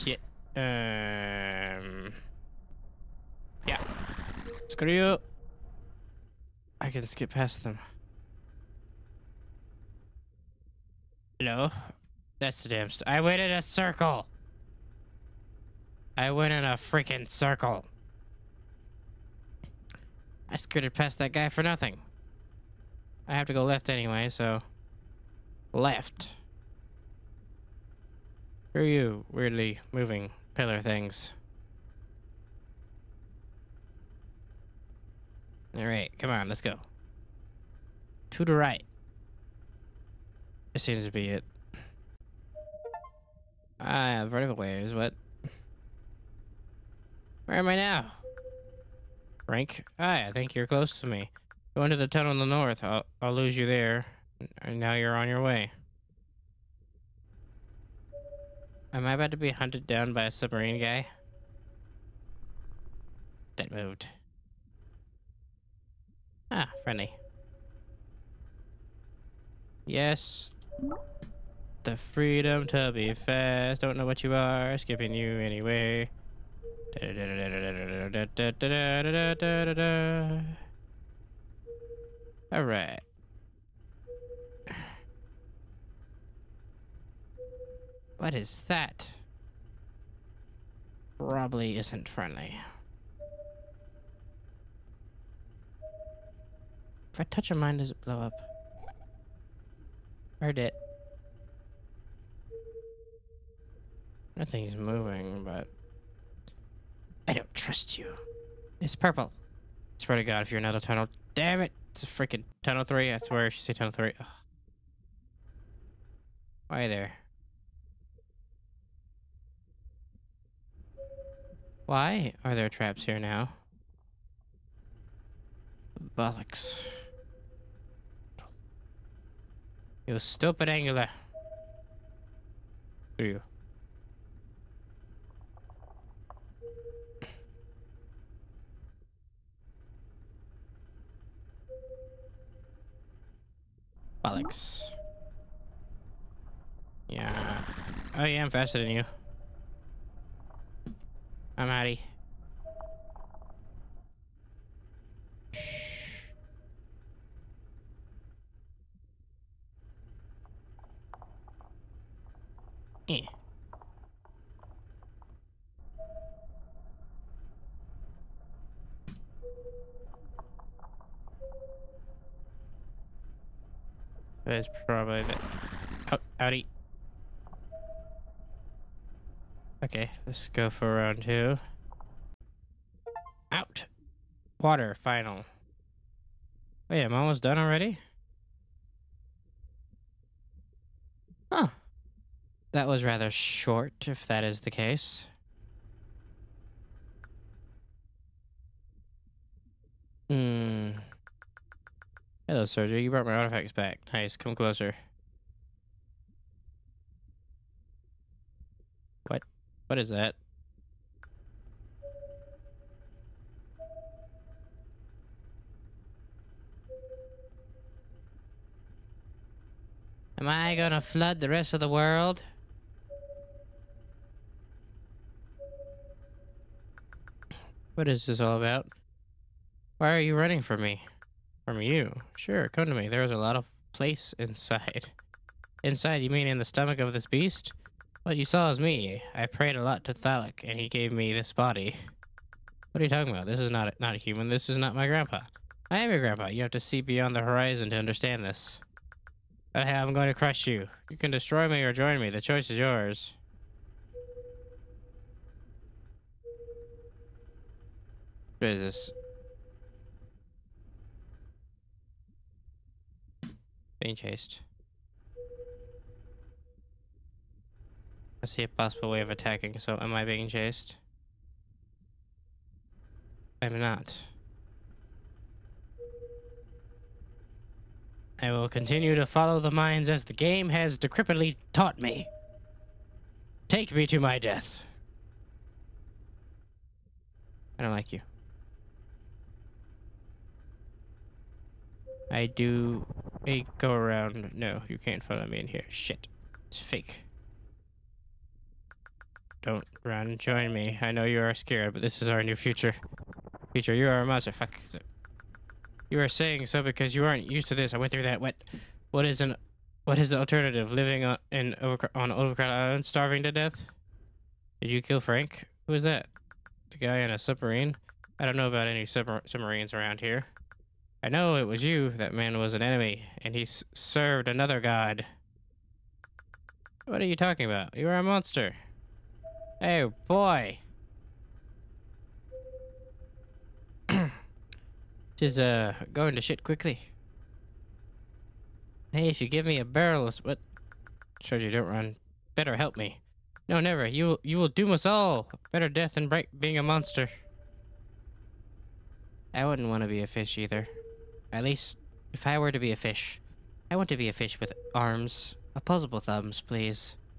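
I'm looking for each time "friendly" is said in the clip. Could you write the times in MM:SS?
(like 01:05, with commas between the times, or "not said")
01:06, 01:32.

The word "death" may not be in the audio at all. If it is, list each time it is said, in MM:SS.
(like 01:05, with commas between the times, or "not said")
04:44, 05:13, 05:45.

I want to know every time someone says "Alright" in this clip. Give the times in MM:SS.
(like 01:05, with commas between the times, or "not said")
00:35, 01:22.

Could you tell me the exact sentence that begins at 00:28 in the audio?
Who are you, weirdly moving pillar things?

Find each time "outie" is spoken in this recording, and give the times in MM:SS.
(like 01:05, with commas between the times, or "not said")
02:31, 02:56.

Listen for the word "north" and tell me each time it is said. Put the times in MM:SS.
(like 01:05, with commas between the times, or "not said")
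00:52.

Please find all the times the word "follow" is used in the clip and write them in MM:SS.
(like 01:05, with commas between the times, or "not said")
04:39, 04:55.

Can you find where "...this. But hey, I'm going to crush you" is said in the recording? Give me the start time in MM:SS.
04:08.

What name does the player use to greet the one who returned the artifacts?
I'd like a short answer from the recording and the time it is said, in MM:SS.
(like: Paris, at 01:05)
Sergio, at 03:22.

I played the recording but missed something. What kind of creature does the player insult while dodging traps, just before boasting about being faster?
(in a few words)
Angler.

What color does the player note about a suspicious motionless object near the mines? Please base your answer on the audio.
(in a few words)
Purple.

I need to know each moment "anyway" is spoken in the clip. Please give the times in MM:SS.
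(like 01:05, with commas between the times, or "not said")
00:23, 01:15.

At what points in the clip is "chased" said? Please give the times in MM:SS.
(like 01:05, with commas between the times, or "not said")
04:24, 04:30.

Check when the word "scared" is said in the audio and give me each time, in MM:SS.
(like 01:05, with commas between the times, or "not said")
05:01.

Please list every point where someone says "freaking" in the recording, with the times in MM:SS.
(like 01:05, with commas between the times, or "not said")
00:16, 01:52.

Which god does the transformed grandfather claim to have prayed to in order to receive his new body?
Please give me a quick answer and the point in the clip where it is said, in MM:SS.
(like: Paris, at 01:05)
Thalik, at 04:00.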